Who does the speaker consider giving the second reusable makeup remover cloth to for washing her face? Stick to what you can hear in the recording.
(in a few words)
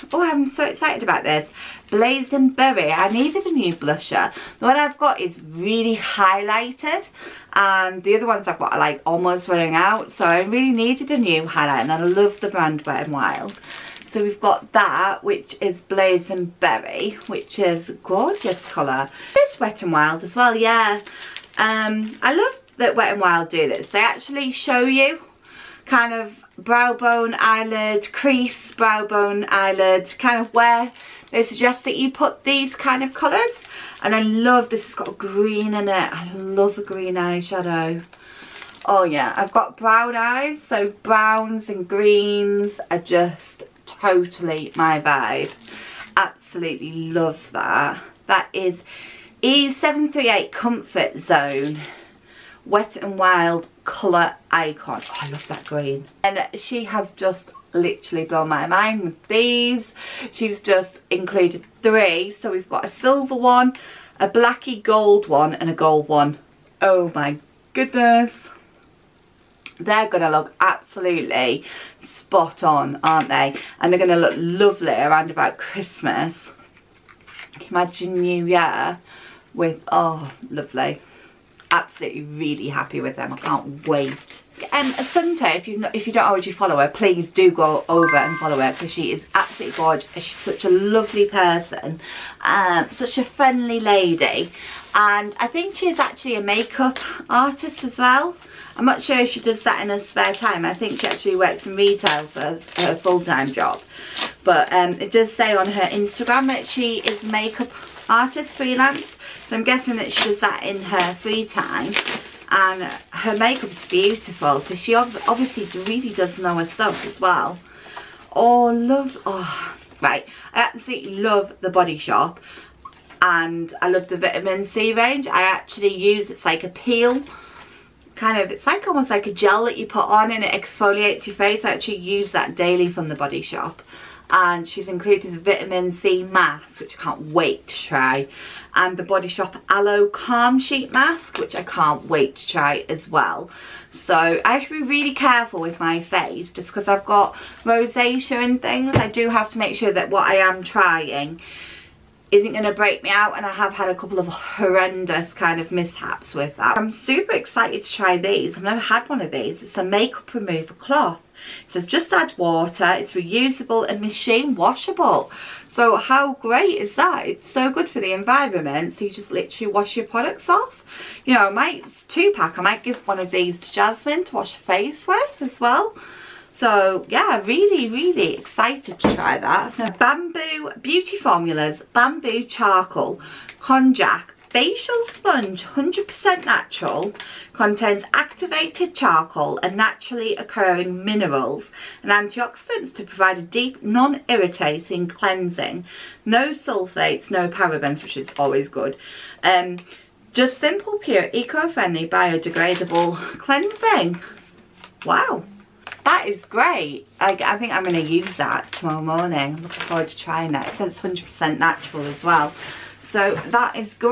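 Jasmine.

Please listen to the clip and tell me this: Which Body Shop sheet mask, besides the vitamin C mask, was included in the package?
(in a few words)
Aloe Calm.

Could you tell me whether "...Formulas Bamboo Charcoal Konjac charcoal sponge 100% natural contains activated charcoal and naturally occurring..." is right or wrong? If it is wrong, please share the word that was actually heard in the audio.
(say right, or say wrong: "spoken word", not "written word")
wrong: "facial", not "charcoal".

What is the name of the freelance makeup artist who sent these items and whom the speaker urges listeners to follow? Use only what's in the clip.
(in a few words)
Assunta.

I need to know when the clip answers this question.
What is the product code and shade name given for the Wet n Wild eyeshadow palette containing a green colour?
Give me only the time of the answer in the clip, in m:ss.
0:49.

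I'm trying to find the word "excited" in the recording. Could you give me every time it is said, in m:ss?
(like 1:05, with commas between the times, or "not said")
0:00, 2:37, 2:58.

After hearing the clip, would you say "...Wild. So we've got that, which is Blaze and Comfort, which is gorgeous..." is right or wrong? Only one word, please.
wrong.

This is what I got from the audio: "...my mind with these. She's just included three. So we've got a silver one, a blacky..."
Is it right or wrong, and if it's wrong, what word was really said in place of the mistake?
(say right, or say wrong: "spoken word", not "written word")
right.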